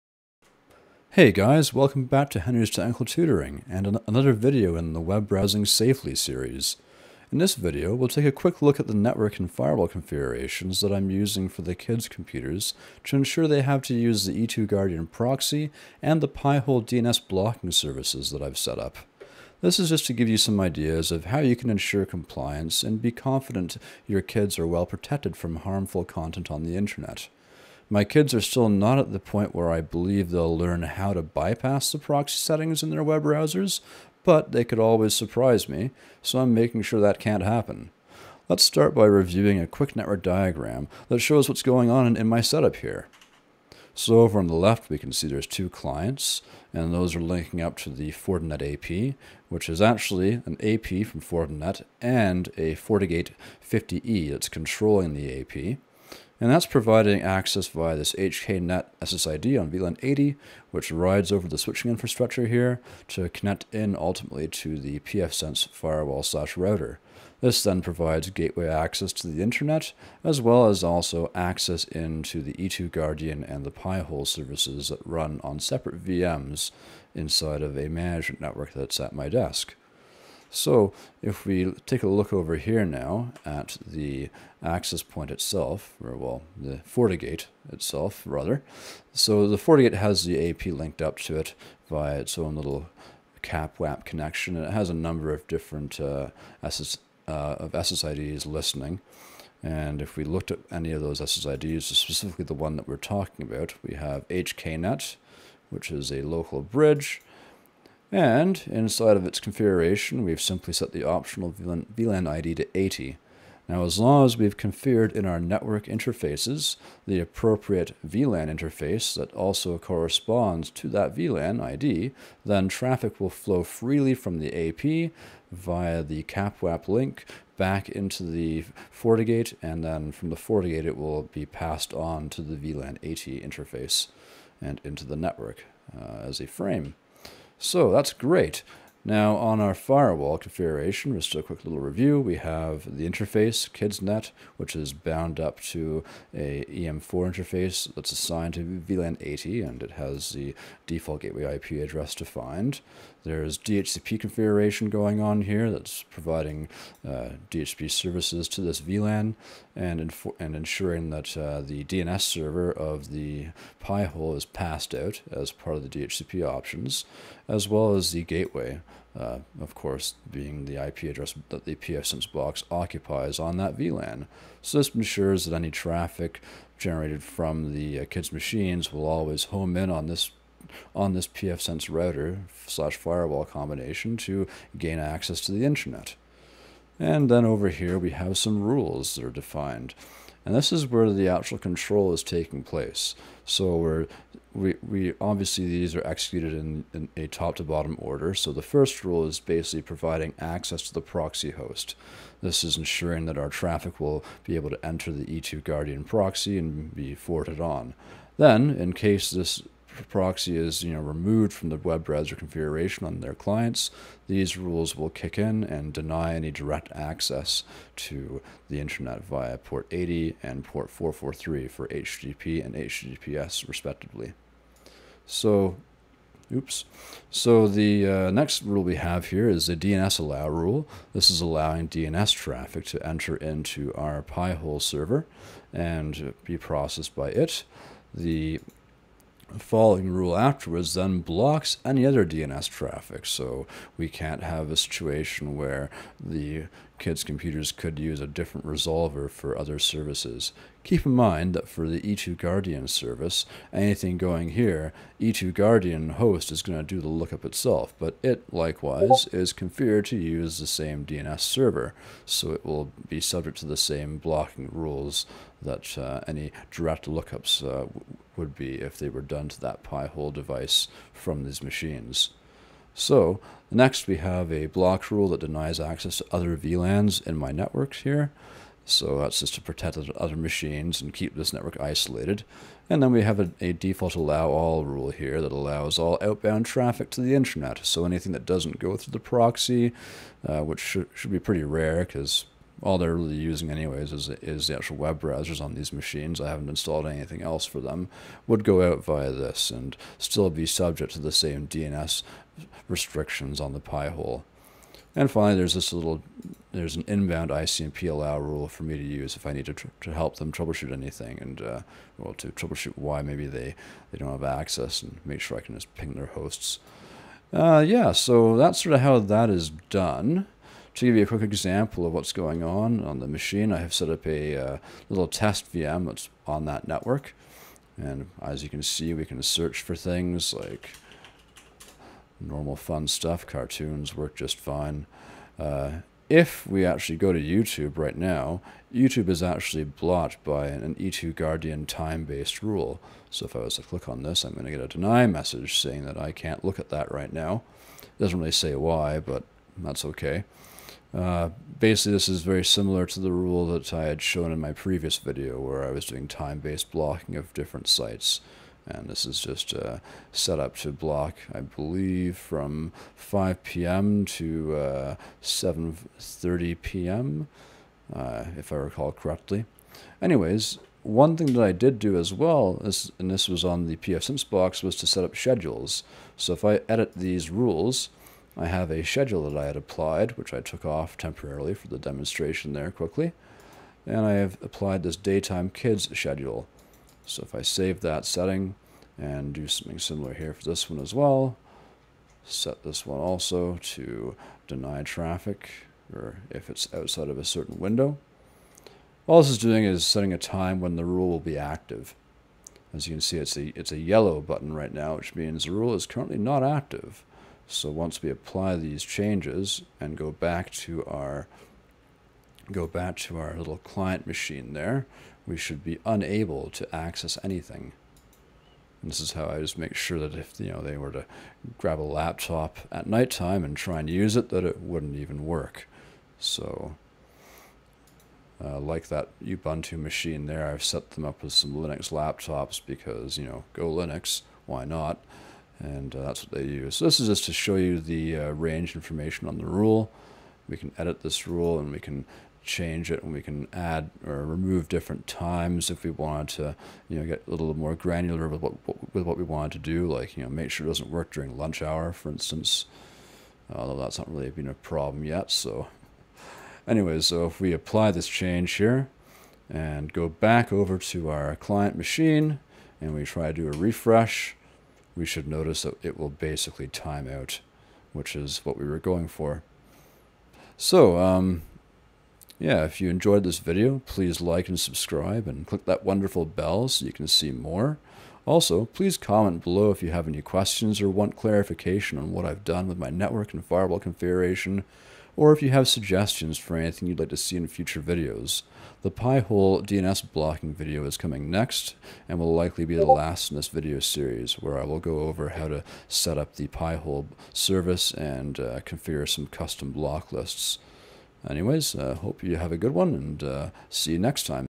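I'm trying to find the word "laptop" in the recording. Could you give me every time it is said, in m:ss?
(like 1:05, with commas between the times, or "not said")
7:02, 7:12.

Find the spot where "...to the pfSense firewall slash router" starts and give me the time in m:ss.
1:04.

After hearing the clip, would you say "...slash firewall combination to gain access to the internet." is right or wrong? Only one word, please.
right.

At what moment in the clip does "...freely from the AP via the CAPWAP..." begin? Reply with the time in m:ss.
2:03.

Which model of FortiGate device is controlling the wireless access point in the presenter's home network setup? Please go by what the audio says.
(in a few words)
FortiGate 50E.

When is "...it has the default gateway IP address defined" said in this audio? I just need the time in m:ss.
2:29.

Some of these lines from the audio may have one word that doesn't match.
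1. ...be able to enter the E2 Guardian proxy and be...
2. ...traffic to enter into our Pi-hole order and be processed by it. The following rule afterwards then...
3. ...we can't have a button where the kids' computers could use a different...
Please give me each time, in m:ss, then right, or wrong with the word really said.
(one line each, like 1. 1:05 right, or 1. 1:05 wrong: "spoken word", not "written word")
1. 3:24 right
2. 3:52 wrong: "server", not "order"
3. 4:03 wrong: "situation", not "button".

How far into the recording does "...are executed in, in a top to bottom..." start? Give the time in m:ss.
3:15.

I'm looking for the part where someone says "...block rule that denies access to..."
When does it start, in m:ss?
4:34.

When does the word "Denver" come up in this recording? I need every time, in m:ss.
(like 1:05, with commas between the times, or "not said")
not said.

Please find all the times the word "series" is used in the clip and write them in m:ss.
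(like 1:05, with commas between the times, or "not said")
0:06, 8:13.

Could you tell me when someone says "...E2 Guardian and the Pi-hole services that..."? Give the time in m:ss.
1:12.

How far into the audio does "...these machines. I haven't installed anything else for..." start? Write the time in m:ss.
4:55.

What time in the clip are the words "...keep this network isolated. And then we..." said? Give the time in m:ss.
4:41.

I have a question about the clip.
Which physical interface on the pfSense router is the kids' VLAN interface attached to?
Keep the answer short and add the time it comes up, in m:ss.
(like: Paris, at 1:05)
EM4, at 2:26.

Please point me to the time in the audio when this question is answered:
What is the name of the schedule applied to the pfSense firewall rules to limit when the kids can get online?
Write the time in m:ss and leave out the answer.
6:25.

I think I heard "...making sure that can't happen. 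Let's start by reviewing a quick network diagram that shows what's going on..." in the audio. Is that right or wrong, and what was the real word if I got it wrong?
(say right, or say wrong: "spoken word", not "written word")
right.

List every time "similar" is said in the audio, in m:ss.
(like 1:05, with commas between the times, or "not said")
5:52, 6:29.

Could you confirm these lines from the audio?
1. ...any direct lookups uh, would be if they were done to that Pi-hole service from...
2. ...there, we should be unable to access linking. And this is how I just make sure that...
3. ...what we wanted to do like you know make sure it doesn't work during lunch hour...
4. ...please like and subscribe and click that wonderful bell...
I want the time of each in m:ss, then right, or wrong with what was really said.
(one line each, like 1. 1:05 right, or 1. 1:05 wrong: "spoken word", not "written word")
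1. 4:26 wrong: "device", not "service"
2. 6:54 wrong: "anything", not "linking"
3. 7:29 right
4. 7:54 right.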